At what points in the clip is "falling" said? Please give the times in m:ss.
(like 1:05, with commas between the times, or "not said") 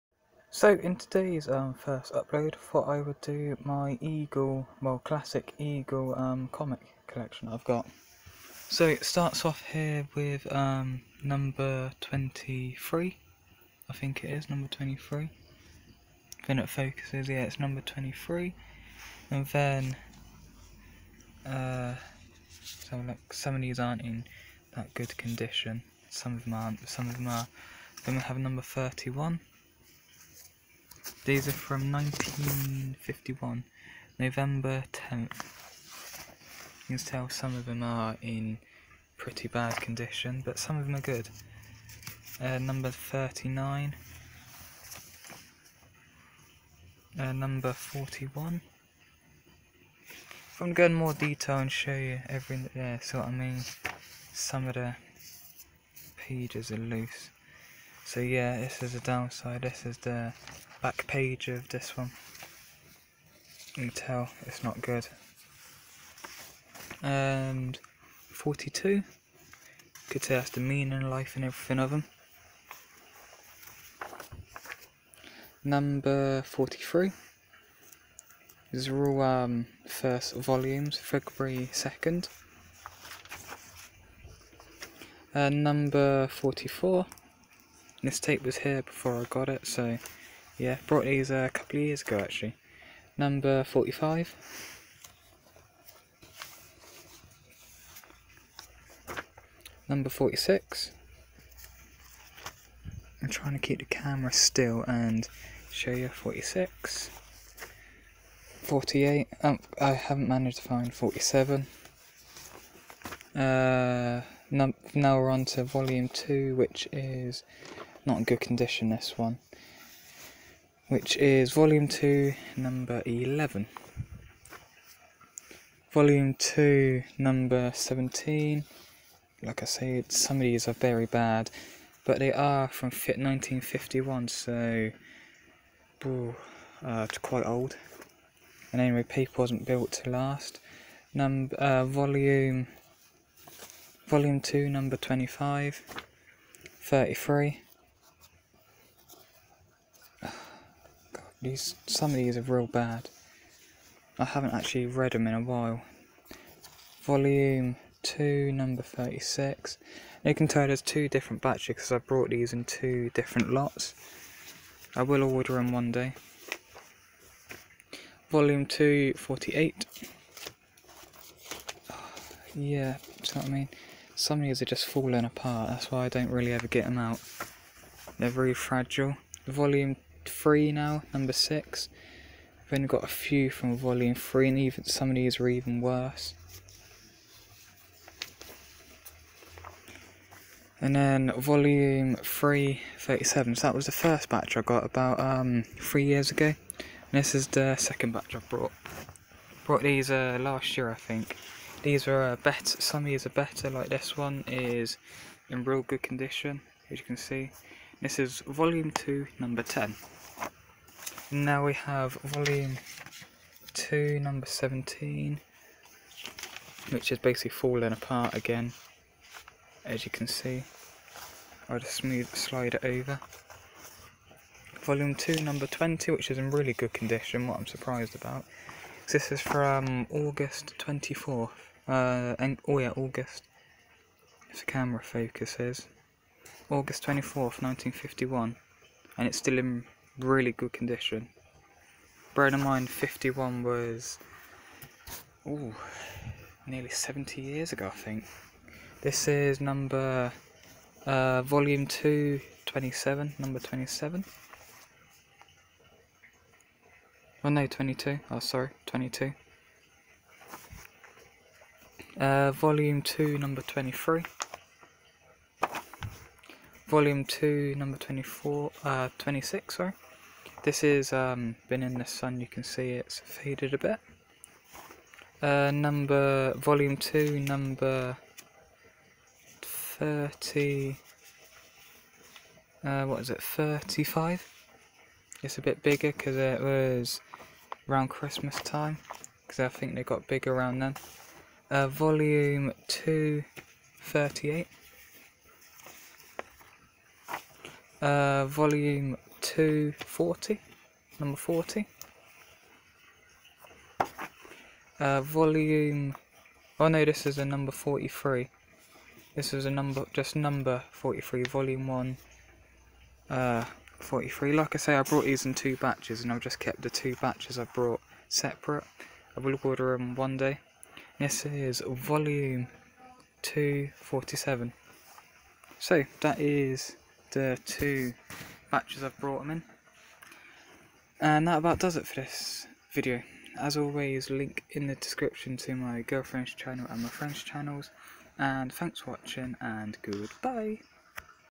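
2:54, 3:37.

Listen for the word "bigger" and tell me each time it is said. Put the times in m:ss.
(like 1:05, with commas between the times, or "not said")
4:45, 4:50.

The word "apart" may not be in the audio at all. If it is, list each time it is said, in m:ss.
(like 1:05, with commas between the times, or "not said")
2:55, 3:37.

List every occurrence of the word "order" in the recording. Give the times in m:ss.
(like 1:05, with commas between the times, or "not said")
2:45, 5:19.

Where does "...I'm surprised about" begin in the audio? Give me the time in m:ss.
3:47.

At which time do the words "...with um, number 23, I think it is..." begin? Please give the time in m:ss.
0:10.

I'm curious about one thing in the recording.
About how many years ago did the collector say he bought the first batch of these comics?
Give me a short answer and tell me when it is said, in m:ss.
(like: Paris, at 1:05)
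3, at 3:15.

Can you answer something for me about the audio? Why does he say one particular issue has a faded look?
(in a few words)
Been in the sun.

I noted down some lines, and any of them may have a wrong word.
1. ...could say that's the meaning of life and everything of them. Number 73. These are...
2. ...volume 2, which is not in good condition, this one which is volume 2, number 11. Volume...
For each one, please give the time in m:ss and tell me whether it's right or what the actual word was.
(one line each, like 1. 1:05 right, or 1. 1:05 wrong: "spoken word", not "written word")
1. 1:10 wrong: "43", not "73"
2. 1:55 right.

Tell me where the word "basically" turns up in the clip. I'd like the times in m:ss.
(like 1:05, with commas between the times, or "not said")
3:37.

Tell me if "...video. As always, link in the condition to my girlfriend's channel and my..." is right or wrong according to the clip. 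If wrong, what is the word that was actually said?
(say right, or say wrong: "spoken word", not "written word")
wrong: "description", not "condition".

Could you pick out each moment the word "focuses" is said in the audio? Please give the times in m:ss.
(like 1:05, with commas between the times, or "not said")
0:16, 3:55.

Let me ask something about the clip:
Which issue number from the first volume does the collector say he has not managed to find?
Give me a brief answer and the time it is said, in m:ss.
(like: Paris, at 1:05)
47, at 1:50.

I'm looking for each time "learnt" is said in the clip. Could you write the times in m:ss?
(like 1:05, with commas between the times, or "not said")
not said.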